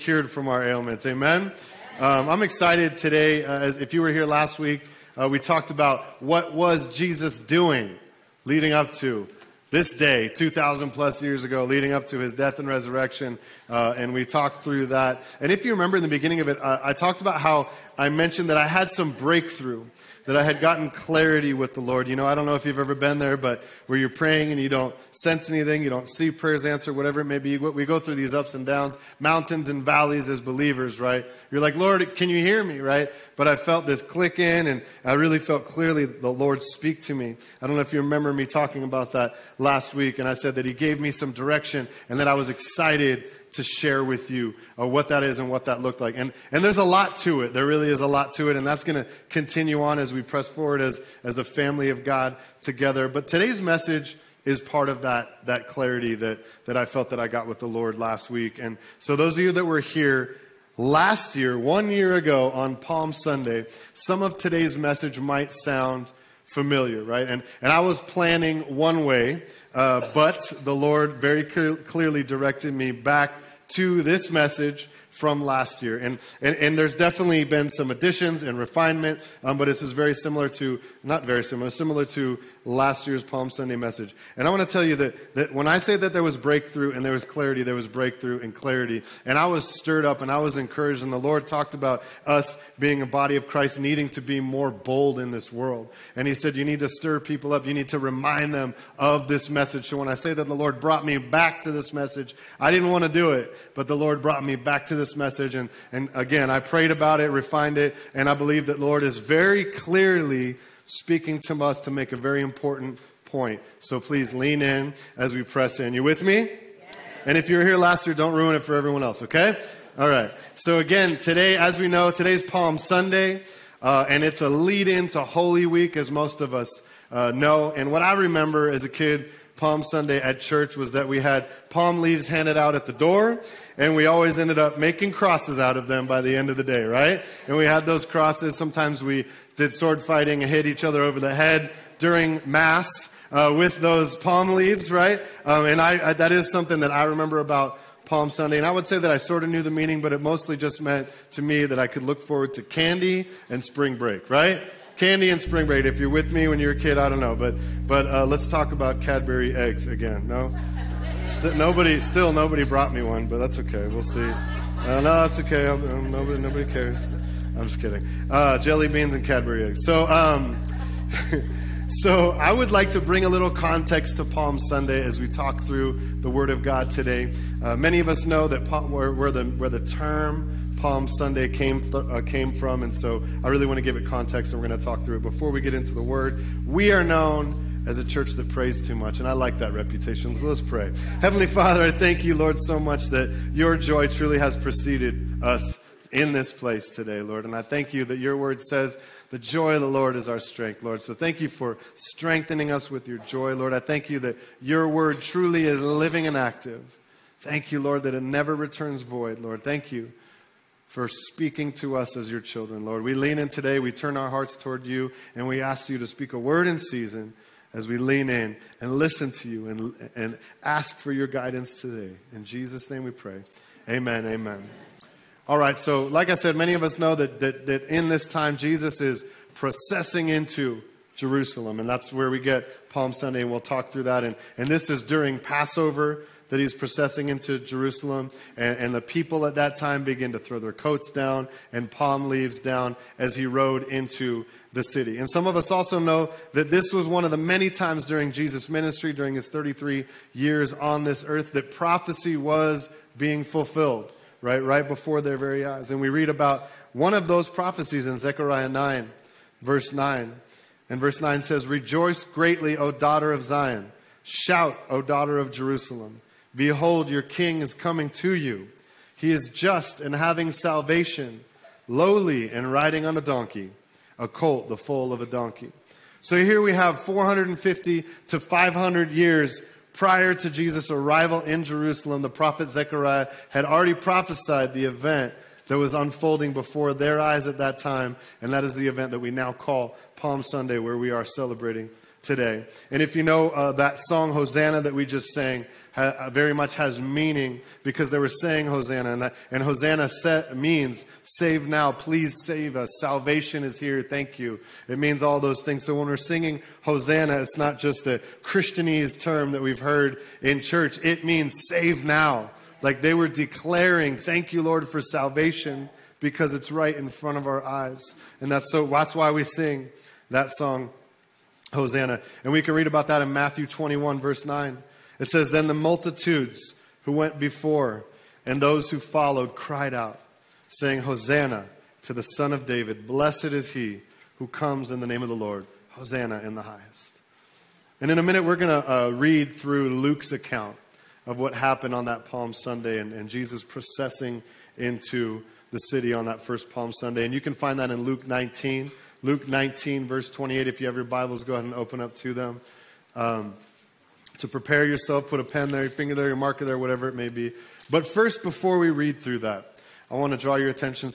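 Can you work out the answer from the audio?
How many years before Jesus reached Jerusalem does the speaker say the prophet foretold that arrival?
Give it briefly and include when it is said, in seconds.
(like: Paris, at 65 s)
450 to 500, at 276 s.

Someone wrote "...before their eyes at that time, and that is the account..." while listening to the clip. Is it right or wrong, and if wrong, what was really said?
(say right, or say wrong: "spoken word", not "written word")
wrong: "event", not "account".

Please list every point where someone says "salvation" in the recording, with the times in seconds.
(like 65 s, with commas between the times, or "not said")
270 s, 302 s, 315 s.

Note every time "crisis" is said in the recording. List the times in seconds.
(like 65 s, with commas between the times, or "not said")
not said.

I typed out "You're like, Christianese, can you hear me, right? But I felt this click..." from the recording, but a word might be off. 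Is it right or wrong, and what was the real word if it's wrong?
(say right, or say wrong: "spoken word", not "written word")
wrong: "Lord", not "Christianese".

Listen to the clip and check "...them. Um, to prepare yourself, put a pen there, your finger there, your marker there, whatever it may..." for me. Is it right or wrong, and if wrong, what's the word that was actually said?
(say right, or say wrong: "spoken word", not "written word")
right.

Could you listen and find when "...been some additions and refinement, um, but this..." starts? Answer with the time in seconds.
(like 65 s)
77 s.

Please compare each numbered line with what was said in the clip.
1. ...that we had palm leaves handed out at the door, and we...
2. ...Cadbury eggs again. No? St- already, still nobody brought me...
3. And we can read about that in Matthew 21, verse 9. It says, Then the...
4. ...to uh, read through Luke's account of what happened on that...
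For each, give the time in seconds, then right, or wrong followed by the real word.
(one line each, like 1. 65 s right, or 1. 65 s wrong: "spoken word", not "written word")
1. 130 s right
2. 159 s wrong: "nobody", not "already"
3. 322 s right
4. 338 s right.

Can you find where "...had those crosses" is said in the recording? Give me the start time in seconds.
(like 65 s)
137 s.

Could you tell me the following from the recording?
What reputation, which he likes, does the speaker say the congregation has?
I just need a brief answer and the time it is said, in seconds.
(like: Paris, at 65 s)
A church that prays too much, at 188 s.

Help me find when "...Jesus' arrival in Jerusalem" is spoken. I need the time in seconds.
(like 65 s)
280 s.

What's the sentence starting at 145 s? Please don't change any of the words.
Um, and I, I, that is something that I remember about Palm Sunday.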